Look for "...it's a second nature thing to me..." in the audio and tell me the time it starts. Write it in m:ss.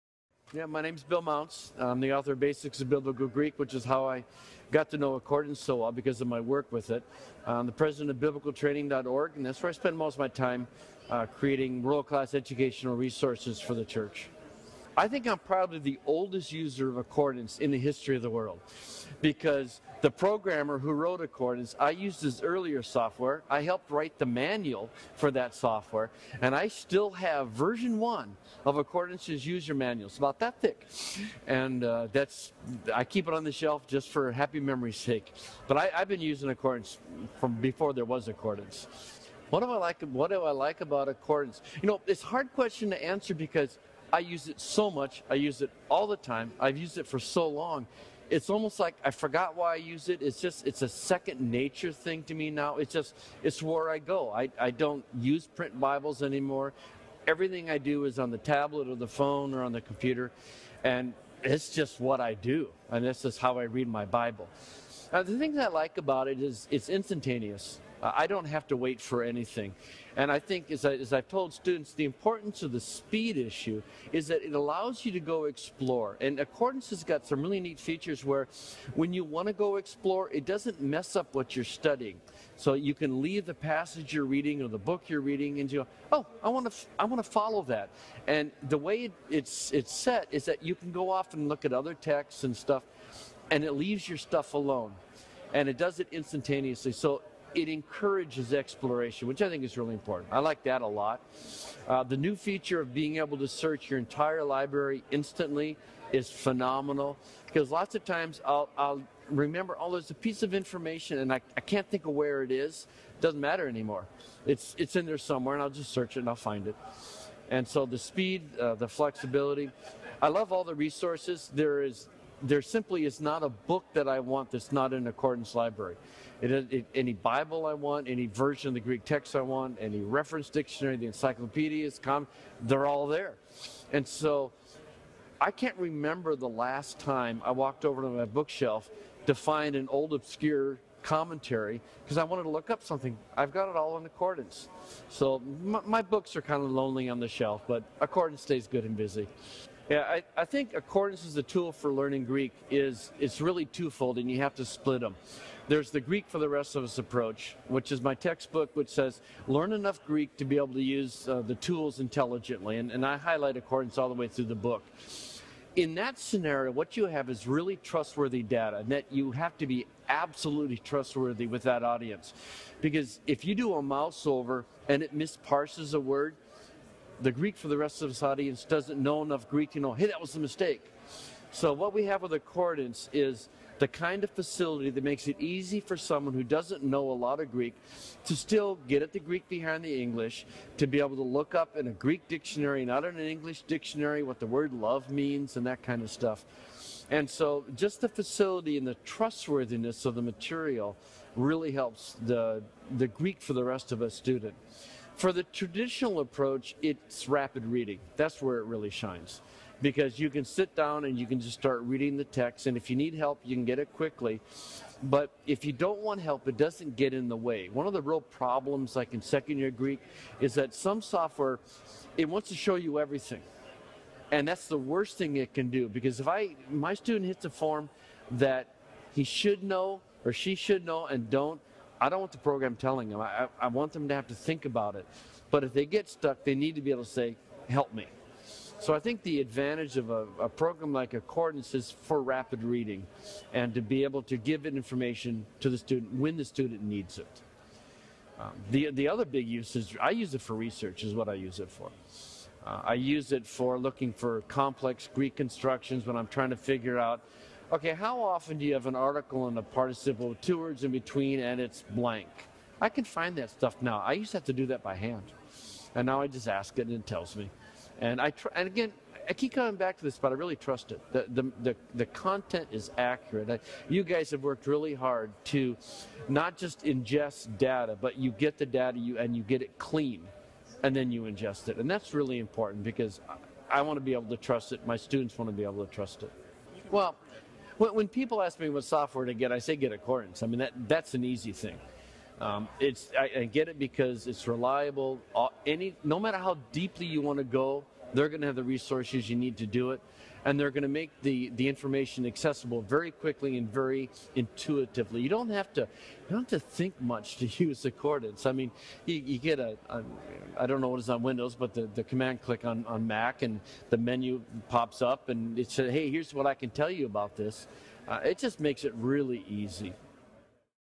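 0:50.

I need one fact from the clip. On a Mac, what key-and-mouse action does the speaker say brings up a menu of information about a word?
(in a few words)
command click.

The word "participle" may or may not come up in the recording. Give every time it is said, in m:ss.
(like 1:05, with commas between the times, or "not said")
4:19.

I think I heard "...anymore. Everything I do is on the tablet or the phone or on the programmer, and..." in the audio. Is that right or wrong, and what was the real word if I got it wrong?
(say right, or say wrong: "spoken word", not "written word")
wrong: "computer", not "programmer".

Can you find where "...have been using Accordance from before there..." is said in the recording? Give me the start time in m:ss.
0:35.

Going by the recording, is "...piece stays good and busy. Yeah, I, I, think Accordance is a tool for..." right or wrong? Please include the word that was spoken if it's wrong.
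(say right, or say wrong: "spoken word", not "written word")
wrong: "accordance", not "piece".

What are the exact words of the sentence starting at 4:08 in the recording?
Um, the, the other big use is I use it for research is what I use it for.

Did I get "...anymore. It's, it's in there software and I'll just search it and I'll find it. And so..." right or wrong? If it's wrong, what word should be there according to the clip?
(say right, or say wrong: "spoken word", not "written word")
wrong: "somewhere", not "software".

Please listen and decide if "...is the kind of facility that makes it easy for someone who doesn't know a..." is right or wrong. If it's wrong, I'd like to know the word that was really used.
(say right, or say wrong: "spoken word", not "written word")
right.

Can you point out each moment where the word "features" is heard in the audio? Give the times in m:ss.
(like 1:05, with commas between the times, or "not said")
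1:17, 1:42.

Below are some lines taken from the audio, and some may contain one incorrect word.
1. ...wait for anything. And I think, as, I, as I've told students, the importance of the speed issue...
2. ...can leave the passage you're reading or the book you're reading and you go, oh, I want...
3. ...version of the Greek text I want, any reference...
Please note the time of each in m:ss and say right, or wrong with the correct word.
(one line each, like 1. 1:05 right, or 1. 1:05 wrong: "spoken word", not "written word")
1. 1:08 right
2. 1:22 right
3. 2:08 right.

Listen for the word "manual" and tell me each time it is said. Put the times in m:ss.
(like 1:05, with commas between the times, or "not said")
0:24, 0:29.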